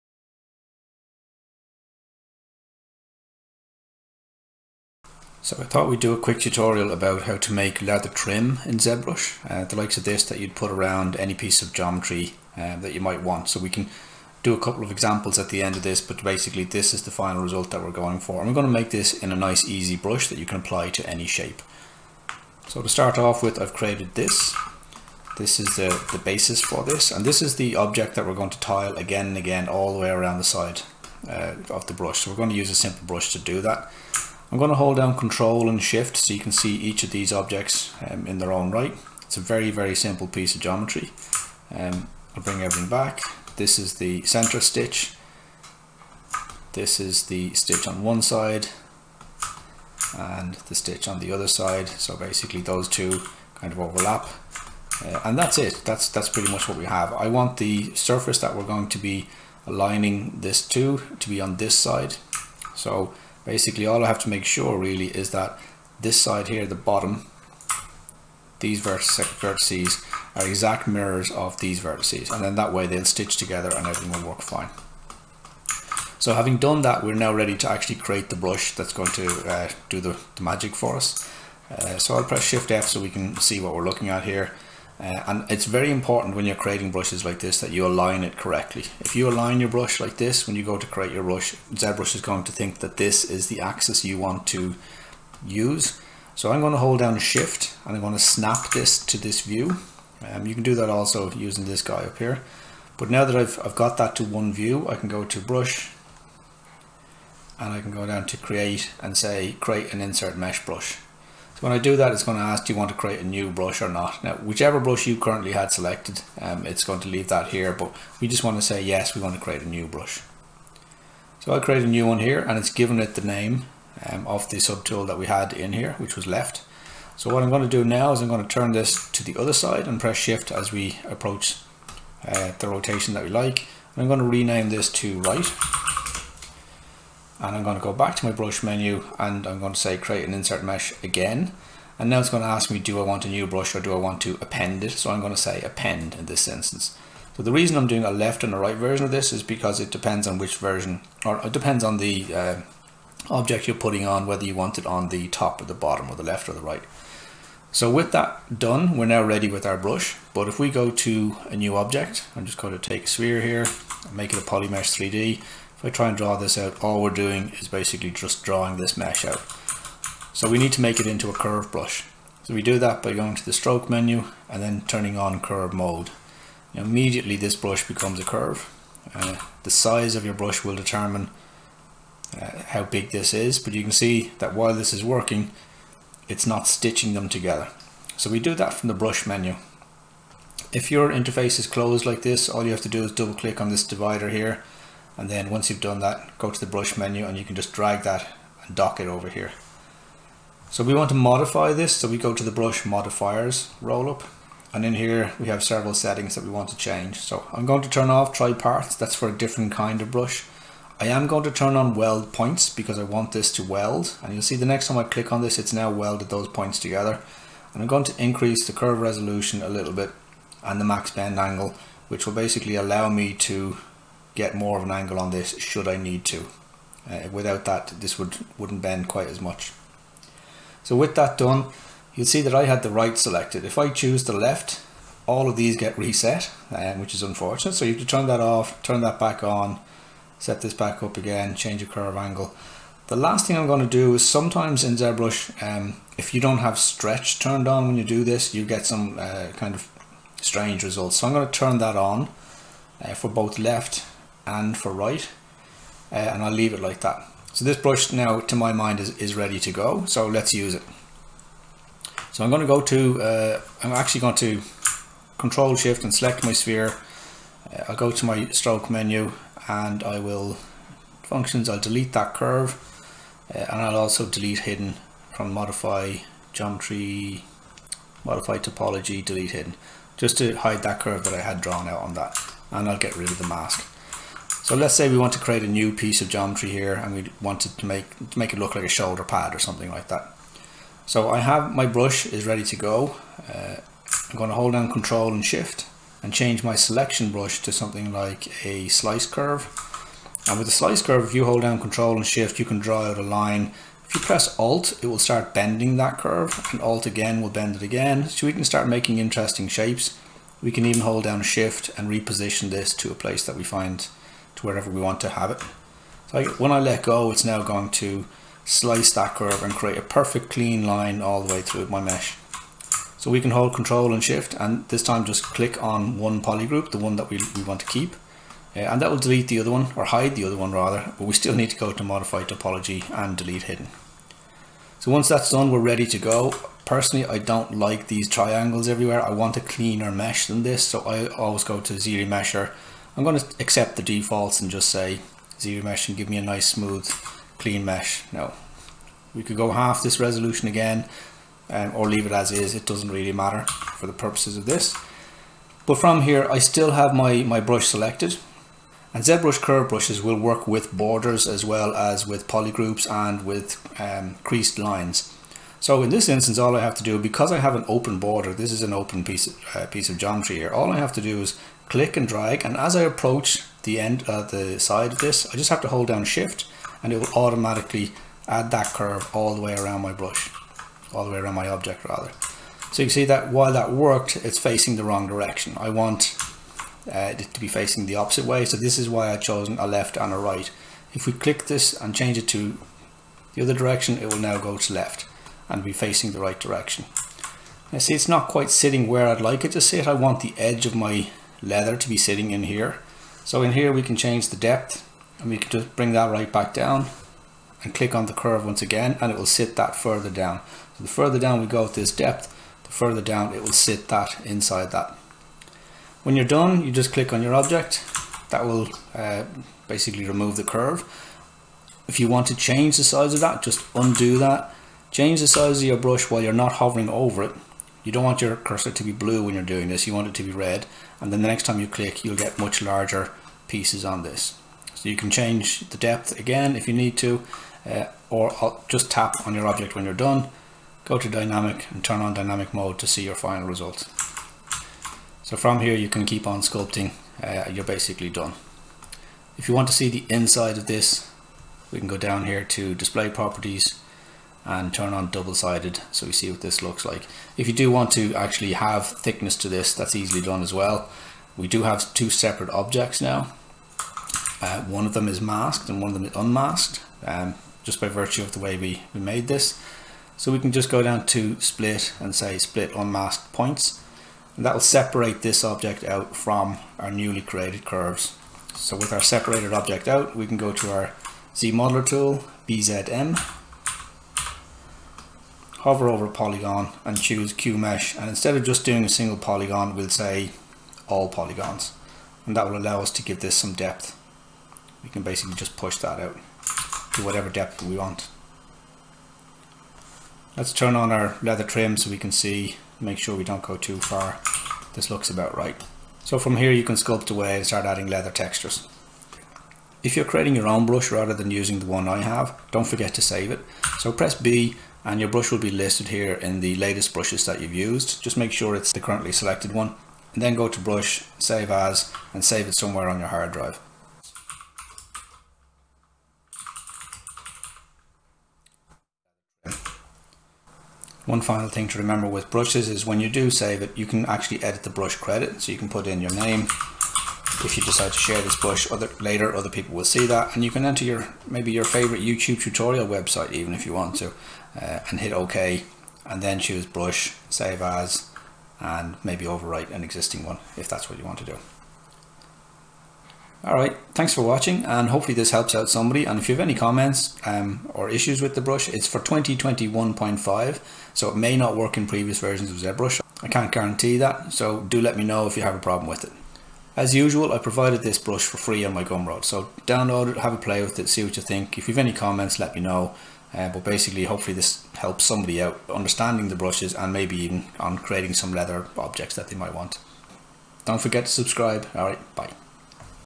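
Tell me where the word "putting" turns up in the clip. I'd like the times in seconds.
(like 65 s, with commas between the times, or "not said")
153 s.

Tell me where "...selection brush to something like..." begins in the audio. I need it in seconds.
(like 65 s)
296 s.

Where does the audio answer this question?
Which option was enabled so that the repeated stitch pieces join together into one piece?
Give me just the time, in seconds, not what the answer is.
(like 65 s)
211 s.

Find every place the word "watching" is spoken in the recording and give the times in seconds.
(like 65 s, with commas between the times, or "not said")
554 s.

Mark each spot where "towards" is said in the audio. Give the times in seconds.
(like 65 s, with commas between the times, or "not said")
not said.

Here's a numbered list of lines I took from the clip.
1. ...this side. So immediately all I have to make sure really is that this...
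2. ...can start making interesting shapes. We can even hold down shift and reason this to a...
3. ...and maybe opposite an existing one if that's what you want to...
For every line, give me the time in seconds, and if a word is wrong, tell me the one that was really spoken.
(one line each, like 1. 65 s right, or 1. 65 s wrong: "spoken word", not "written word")
1. 61 s wrong: "basically", not "immediately"
2. 308 s wrong: "reposition", not "reason"
3. 548 s wrong: "overwrite", not "opposite".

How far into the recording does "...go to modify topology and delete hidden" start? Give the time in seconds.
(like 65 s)
331 s.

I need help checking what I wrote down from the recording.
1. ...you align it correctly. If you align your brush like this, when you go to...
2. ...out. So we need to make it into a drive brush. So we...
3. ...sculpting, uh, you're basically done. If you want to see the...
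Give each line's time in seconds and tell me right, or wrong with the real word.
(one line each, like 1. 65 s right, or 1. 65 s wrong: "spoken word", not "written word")
1. 87 s right
2. 169 s wrong: "curve", not "drive"
3. 446 s right.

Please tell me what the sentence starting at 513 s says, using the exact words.
So press B and your brush will be listed here in the latest brushes that you've used.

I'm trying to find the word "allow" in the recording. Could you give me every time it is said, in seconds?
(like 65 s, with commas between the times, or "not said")
222 s, 492 s.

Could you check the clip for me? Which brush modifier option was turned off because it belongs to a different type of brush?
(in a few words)
Tri Parts.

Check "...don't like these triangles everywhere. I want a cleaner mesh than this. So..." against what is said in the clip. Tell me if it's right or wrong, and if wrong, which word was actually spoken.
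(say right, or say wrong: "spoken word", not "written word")
right.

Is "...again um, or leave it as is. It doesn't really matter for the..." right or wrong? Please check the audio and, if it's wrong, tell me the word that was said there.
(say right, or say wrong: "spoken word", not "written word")
right.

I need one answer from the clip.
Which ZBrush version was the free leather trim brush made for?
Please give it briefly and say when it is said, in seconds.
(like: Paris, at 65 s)
2021.5, at 559 s.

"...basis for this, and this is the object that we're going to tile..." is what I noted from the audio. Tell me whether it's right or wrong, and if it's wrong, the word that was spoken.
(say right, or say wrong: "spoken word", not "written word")
right.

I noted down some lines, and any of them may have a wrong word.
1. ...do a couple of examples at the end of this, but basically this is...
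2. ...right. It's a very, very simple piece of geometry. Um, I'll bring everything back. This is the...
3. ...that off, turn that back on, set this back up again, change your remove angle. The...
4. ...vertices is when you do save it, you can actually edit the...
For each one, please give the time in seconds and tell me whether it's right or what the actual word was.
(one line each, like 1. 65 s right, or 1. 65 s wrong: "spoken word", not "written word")
1. 14 s right
2. 38 s right
3. 238 s wrong: "curve", not "remove"
4. 532 s wrong: "brushes", not "vertices".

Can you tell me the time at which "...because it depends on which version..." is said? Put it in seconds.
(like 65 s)
149 s.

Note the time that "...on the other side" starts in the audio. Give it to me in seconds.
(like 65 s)
51 s.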